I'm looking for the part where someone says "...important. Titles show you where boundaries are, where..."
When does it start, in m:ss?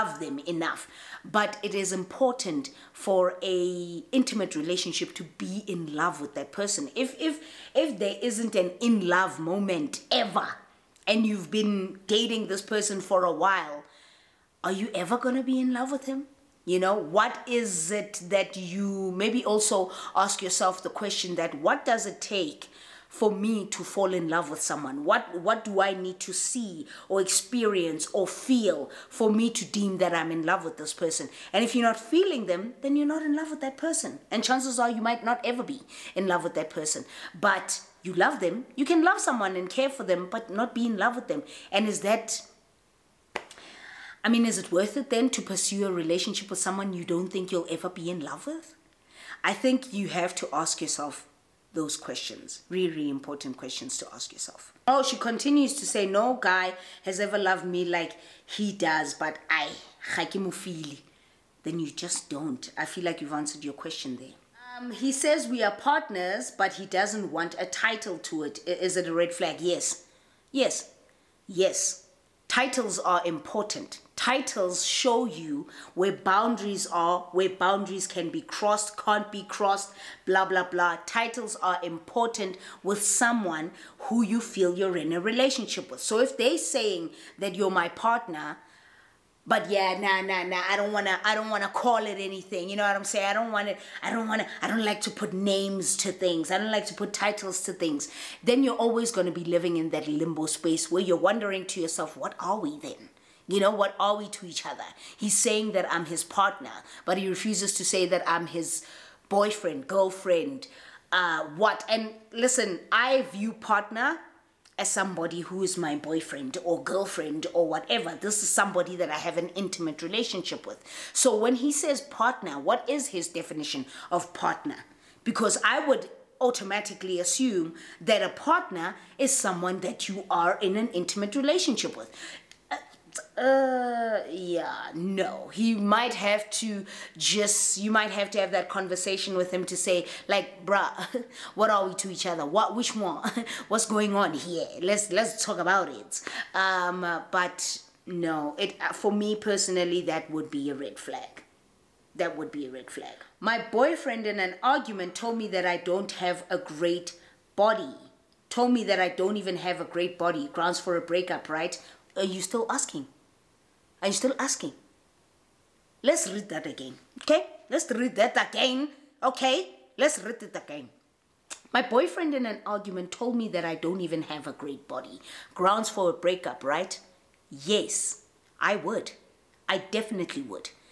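1:13.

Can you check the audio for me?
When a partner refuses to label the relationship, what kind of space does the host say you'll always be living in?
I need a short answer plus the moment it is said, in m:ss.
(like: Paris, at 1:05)
limbo space, at 1:40.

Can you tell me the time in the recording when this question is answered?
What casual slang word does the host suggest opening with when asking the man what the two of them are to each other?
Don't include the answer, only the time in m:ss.
2:20.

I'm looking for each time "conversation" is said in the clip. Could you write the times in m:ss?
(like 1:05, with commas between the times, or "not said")
2:18.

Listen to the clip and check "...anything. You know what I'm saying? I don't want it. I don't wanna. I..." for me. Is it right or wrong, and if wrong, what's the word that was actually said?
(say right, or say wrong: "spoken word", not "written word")
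right.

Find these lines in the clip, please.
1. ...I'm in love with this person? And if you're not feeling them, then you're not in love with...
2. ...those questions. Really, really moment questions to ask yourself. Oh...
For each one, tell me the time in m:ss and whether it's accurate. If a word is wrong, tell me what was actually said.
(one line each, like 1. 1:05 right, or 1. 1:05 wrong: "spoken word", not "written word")
1. 0:30 right
2. 0:51 wrong: "important", not "moment".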